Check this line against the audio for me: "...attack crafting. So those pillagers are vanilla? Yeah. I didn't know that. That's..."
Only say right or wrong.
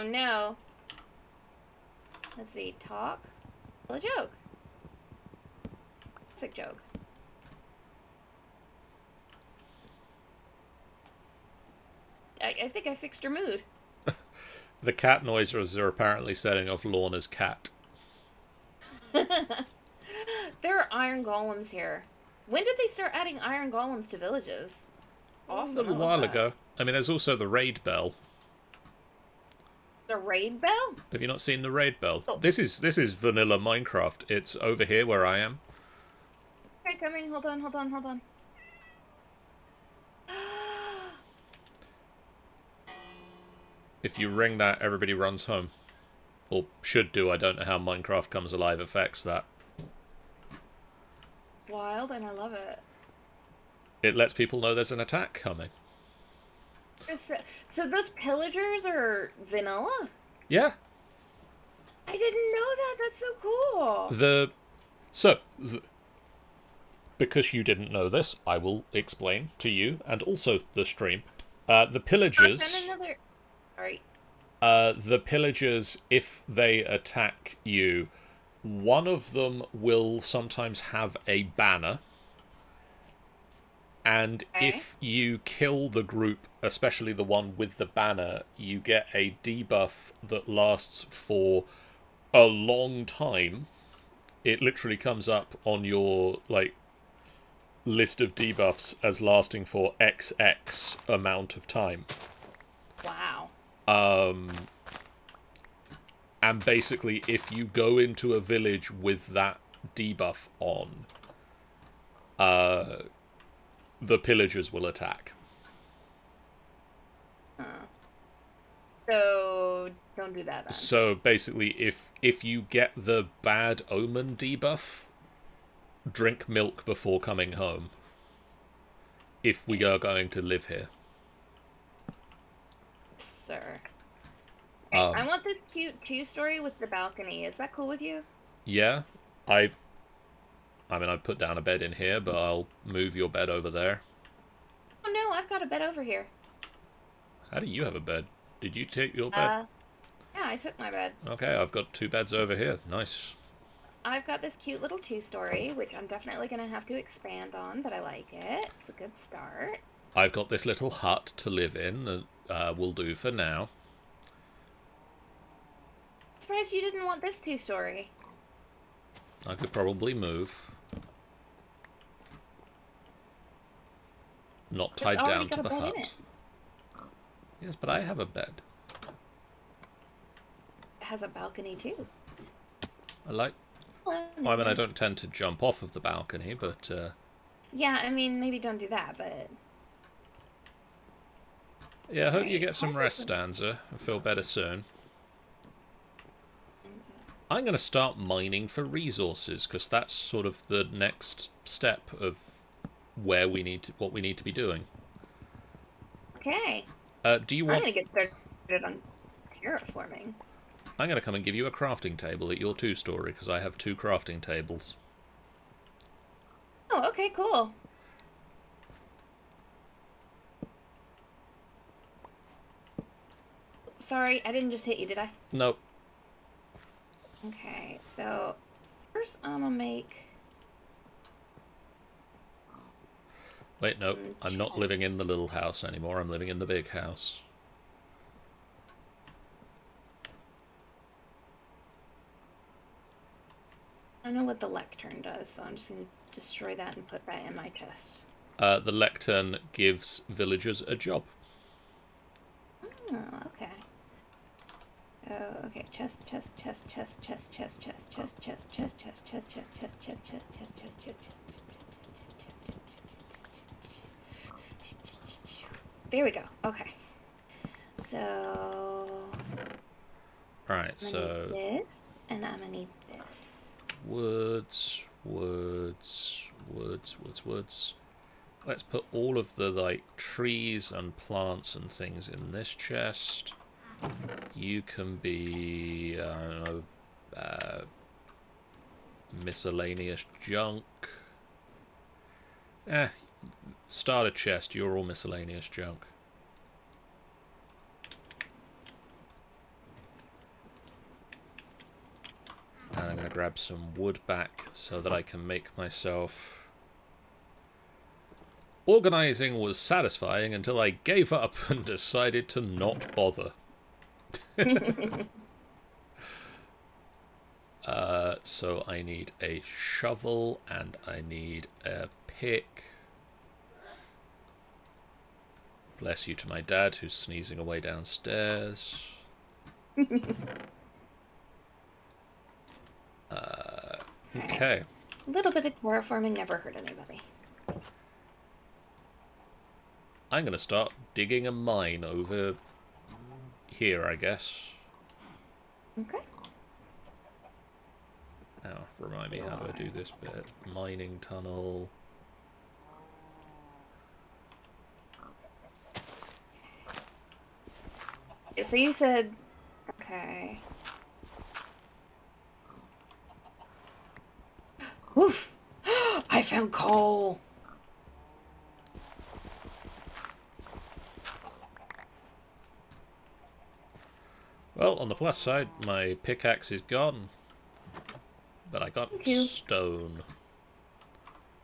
wrong.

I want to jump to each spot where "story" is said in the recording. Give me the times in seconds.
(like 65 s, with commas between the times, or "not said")
136 s, 154 s, 167 s, 212 s.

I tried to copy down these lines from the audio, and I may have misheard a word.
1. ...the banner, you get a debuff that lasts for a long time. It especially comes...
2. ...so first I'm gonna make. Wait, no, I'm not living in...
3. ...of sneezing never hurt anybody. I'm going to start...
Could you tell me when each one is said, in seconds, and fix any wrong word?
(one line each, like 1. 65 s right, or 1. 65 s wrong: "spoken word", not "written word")
1. 87 s wrong: "literally", not "especially"
2. 228 s right
3. 335 s wrong: "terraforming", not "sneezing".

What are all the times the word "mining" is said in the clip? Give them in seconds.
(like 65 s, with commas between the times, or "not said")
198 s, 350 s.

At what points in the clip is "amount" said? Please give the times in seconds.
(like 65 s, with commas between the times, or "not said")
101 s.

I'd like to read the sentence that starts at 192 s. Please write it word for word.
Yeah, I hope you get some rest, Stanza.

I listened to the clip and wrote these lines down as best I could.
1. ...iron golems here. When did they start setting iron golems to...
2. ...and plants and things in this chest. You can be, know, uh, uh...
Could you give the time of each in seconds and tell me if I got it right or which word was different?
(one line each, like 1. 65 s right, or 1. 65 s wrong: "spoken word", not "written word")
1. 20 s wrong: "adding", not "setting"
2. 280 s right.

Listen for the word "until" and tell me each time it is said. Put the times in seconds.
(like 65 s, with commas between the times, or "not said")
310 s.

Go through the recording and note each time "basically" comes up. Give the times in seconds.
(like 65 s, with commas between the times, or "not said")
106 s, 121 s.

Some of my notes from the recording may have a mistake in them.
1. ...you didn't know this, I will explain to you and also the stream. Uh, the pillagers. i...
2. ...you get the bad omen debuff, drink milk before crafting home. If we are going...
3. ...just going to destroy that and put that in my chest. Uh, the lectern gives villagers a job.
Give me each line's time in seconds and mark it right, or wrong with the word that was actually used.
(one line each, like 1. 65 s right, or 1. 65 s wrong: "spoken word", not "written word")
1. 67 s right
2. 122 s wrong: "coming", not "crafting"
3. 245 s right.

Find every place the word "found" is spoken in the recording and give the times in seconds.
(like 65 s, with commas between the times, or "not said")
366 s.